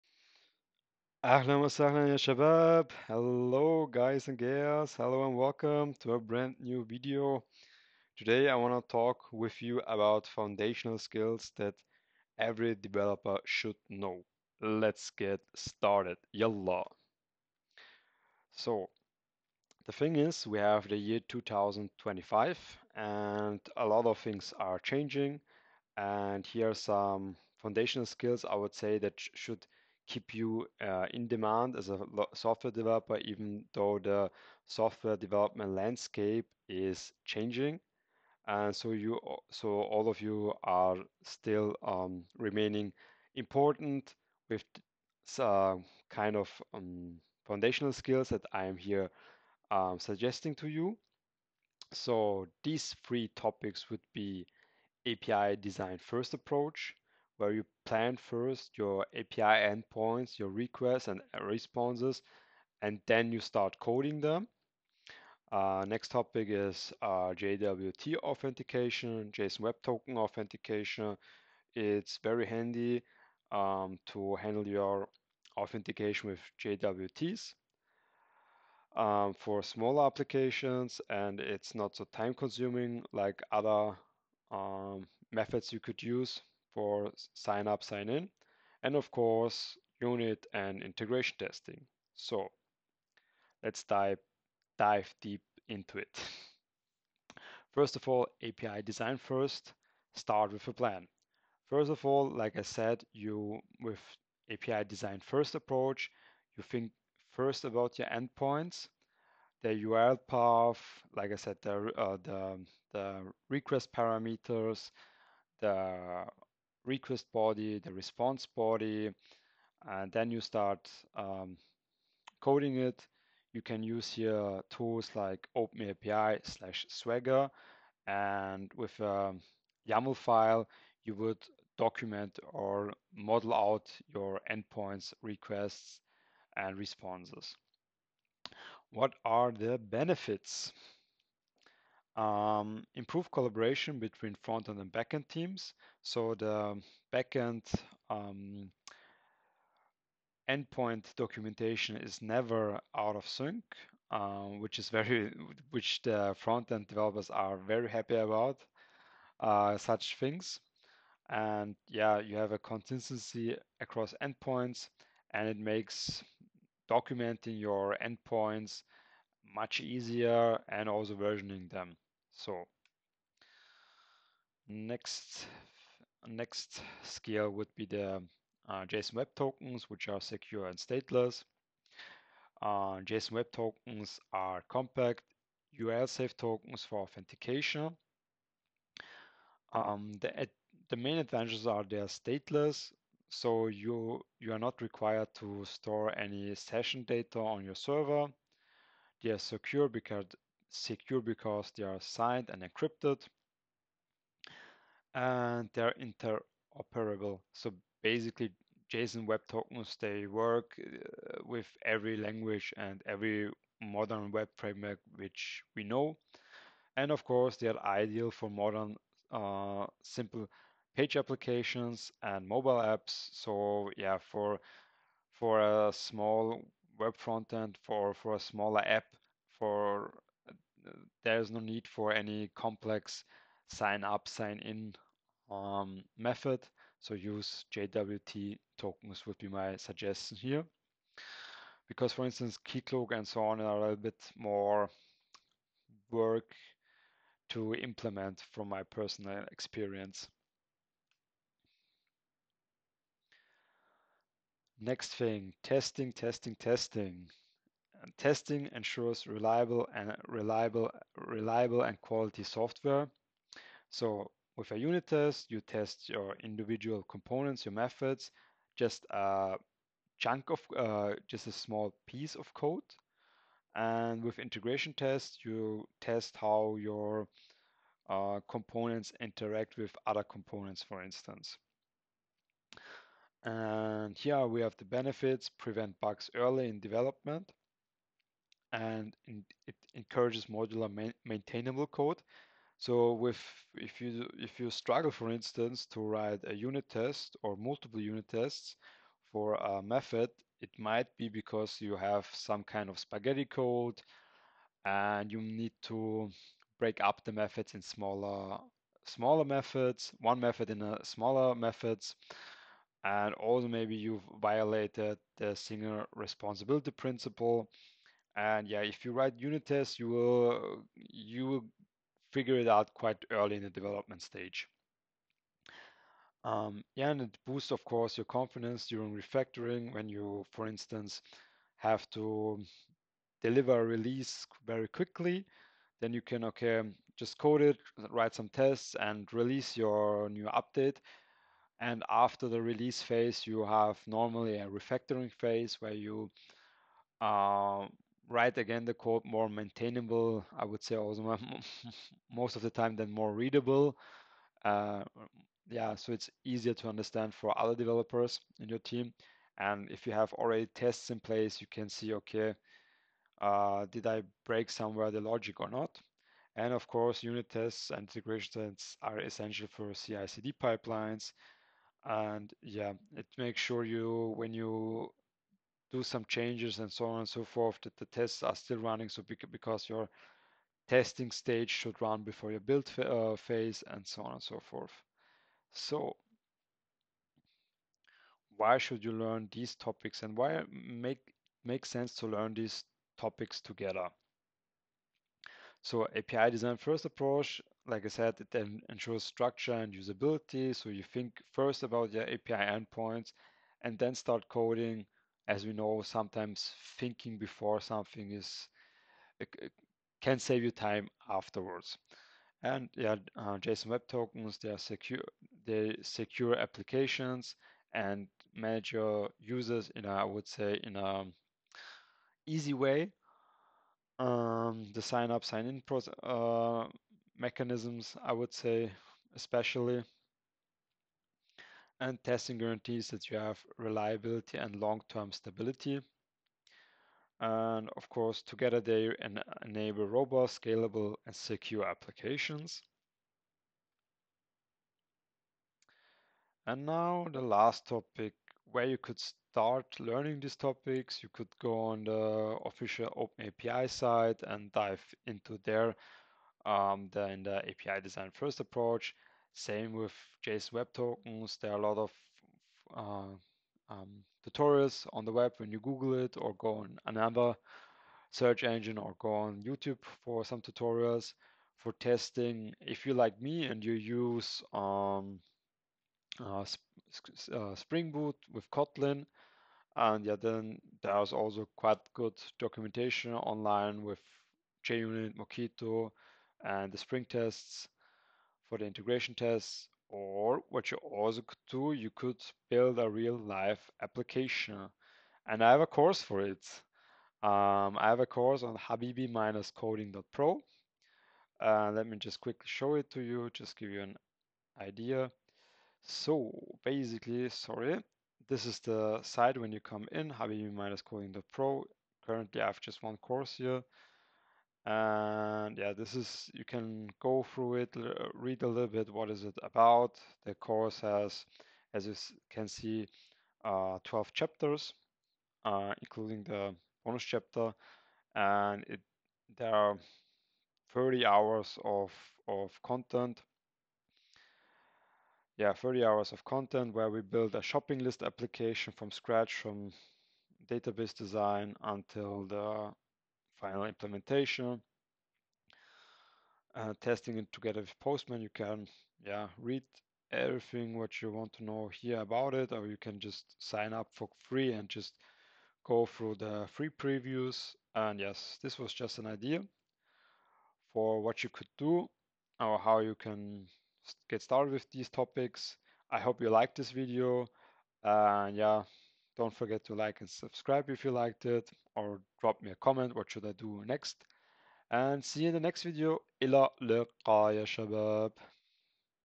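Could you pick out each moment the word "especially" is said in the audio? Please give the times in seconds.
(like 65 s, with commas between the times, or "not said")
429 s.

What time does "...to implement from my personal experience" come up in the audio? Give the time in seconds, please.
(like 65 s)
247 s.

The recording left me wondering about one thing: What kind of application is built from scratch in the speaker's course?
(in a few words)
Shopping list application.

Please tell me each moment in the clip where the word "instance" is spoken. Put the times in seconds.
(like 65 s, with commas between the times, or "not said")
242 s, 281 s, 295 s, 330 s.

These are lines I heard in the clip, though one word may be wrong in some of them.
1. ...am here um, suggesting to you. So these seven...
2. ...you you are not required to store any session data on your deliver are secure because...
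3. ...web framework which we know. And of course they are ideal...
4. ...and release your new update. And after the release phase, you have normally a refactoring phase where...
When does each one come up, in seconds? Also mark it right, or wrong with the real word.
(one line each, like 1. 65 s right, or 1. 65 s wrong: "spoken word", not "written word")
1. 48 s wrong: "three", not "seven"
2. 193 s wrong: "server", not "deliver"
3. 214 s right
4. 338 s right.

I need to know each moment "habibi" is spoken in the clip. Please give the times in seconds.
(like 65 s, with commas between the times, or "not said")
498 s, 510 s.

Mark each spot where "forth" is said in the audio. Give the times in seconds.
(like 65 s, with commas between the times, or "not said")
377 s, 384 s.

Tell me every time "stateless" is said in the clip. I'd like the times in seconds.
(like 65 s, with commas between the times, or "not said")
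180 s, 192 s.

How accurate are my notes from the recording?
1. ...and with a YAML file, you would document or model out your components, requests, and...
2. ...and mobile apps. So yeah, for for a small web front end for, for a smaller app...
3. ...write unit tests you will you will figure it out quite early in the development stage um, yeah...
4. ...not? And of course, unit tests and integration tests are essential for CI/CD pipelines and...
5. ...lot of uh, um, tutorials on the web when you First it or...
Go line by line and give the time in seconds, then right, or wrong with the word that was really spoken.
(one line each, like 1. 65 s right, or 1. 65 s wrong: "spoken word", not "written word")
1. 128 s wrong: "endpoints", not "components"
2. 222 s right
3. 319 s right
4. 365 s right
5. 461 s wrong: "Google", not "First".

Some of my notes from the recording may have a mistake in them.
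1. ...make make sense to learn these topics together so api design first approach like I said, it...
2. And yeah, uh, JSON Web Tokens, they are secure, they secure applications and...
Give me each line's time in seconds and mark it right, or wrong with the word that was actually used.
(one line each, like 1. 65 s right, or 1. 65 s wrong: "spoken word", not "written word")
1. 390 s right
2. 412 s right.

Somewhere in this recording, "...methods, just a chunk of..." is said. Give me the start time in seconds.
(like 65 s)
267 s.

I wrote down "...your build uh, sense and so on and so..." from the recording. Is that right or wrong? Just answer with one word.
wrong.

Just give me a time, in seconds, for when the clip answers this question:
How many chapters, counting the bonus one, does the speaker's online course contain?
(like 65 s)
524 s.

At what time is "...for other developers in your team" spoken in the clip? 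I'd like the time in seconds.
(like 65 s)
357 s.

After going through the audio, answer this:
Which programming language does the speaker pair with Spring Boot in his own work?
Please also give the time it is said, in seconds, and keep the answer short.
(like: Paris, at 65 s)
Kotlin, at 478 s.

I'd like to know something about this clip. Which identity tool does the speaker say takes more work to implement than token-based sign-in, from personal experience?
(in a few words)
Keycloak.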